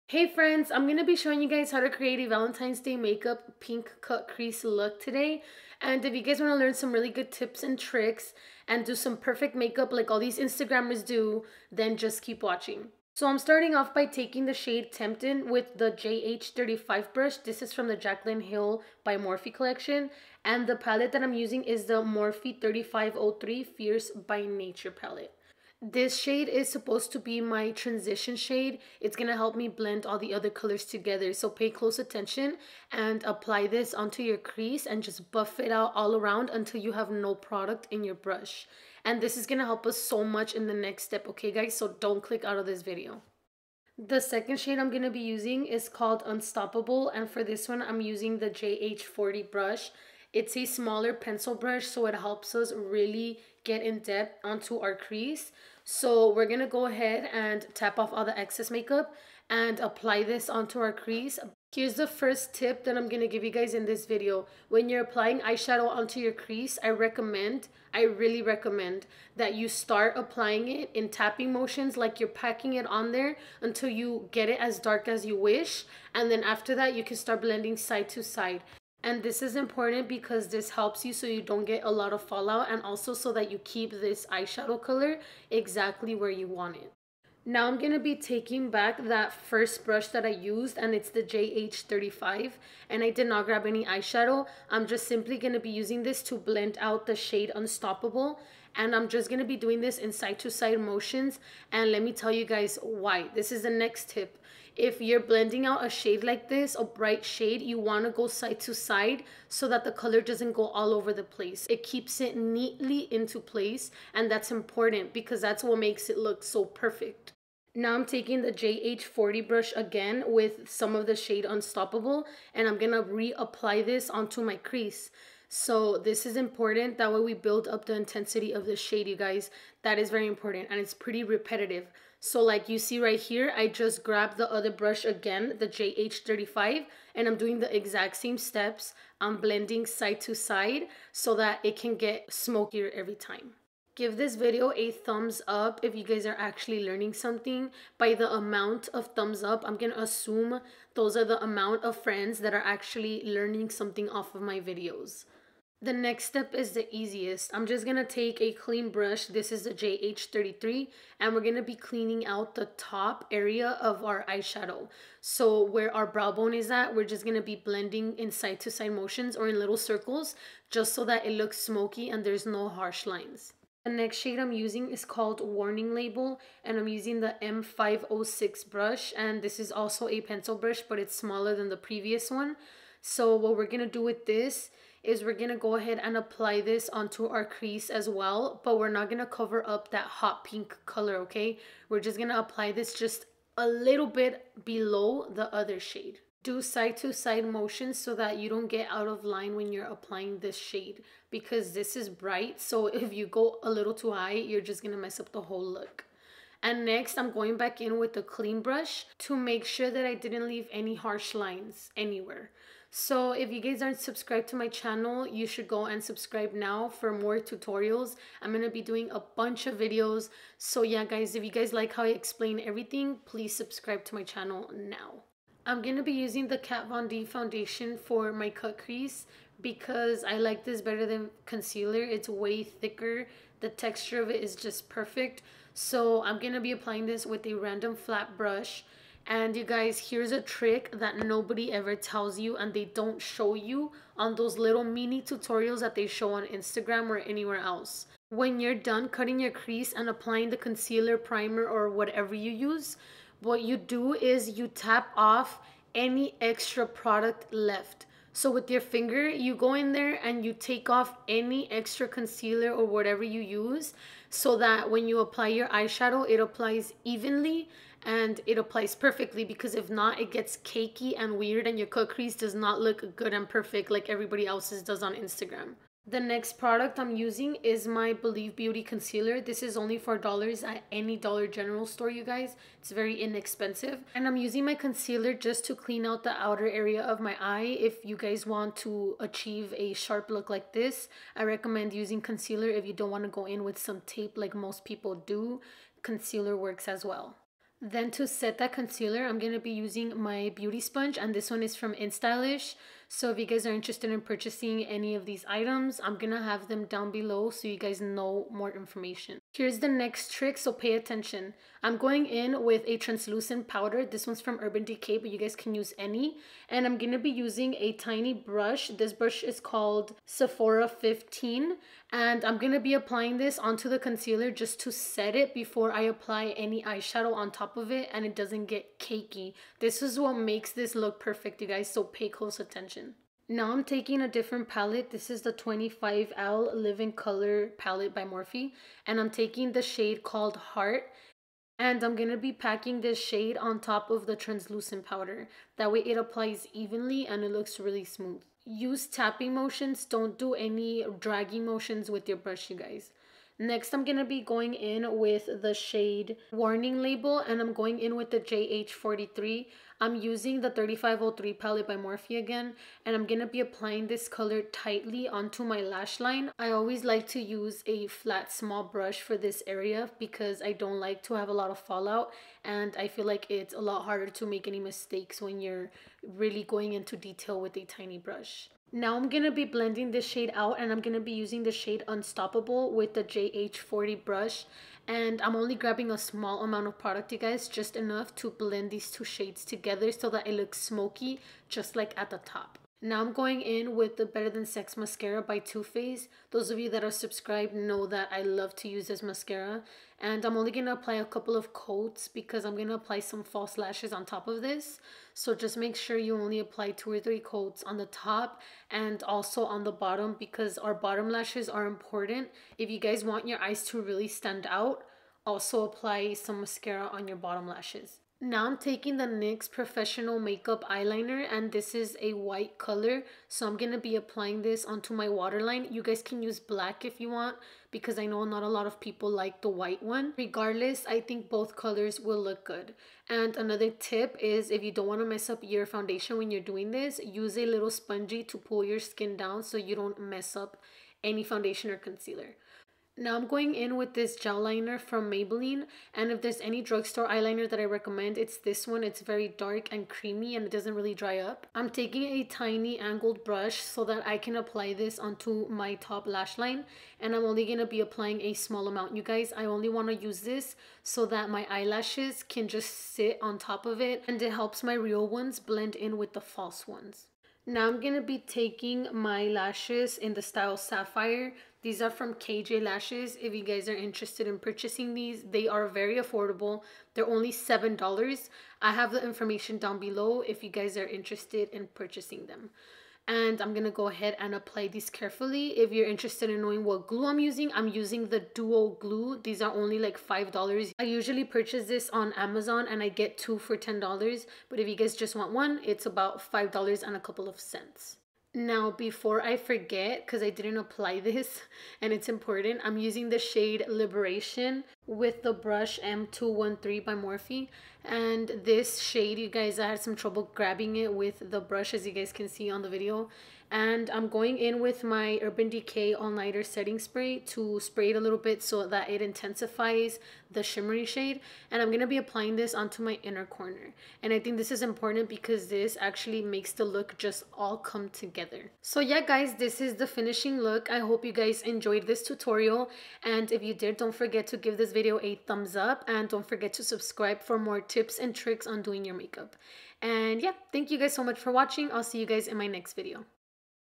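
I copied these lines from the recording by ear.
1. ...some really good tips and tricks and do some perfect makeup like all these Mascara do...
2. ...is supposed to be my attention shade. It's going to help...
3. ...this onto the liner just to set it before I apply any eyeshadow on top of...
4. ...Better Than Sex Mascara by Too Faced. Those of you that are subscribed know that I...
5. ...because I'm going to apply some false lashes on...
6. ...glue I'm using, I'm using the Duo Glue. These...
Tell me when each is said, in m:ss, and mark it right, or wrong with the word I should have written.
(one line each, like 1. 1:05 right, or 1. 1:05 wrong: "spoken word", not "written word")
1. 0:06 wrong: "Instagrammers", not "Mascara"
2. 0:26 wrong: "transition", not "attention"
3. 5:23 wrong: "concealer", not "liner"
4. 6:34 right
5. 6:42 right
6. 8:07 right.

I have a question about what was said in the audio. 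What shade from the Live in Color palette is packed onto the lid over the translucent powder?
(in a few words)
Heart.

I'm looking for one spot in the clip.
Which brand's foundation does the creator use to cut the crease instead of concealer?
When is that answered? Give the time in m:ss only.
3:46.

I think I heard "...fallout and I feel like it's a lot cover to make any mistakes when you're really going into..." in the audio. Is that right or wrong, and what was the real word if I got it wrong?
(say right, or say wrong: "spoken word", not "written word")
wrong: "harder", not "cover".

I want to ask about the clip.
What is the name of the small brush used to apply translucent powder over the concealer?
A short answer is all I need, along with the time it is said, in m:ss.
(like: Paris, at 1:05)
Sephora 15, at 5:20.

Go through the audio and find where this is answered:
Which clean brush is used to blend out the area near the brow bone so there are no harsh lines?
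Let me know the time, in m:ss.
2:39.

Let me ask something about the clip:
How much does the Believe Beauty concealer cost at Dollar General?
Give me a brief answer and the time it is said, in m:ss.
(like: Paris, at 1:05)
$4, at 4:39.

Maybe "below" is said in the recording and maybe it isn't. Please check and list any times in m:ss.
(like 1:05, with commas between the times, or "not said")
3:14, 5:07, 7:59.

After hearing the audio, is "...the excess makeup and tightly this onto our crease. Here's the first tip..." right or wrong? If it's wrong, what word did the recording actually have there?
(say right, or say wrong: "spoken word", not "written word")
wrong: "apply", not "tightly".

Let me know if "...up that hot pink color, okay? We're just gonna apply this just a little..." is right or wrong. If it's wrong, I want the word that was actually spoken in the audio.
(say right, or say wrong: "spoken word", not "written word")
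right.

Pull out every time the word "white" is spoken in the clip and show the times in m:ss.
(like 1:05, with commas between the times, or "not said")
7:02, 7:09.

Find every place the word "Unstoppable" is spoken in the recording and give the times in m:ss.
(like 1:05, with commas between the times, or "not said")
0:46, 1:37, 2:01, 6:22.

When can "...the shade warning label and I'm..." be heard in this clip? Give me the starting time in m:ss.
5:55.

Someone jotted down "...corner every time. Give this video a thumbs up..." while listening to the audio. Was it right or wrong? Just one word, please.
wrong.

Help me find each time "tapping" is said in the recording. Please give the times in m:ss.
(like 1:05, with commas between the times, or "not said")
1:11, 5:49.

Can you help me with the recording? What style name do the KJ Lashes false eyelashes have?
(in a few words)
Sapphire.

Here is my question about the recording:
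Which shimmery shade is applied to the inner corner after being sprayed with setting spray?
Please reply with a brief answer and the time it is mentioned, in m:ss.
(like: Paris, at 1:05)
Liberation, at 8:23.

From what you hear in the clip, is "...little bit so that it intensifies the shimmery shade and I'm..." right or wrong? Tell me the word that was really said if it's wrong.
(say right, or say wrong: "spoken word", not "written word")
right.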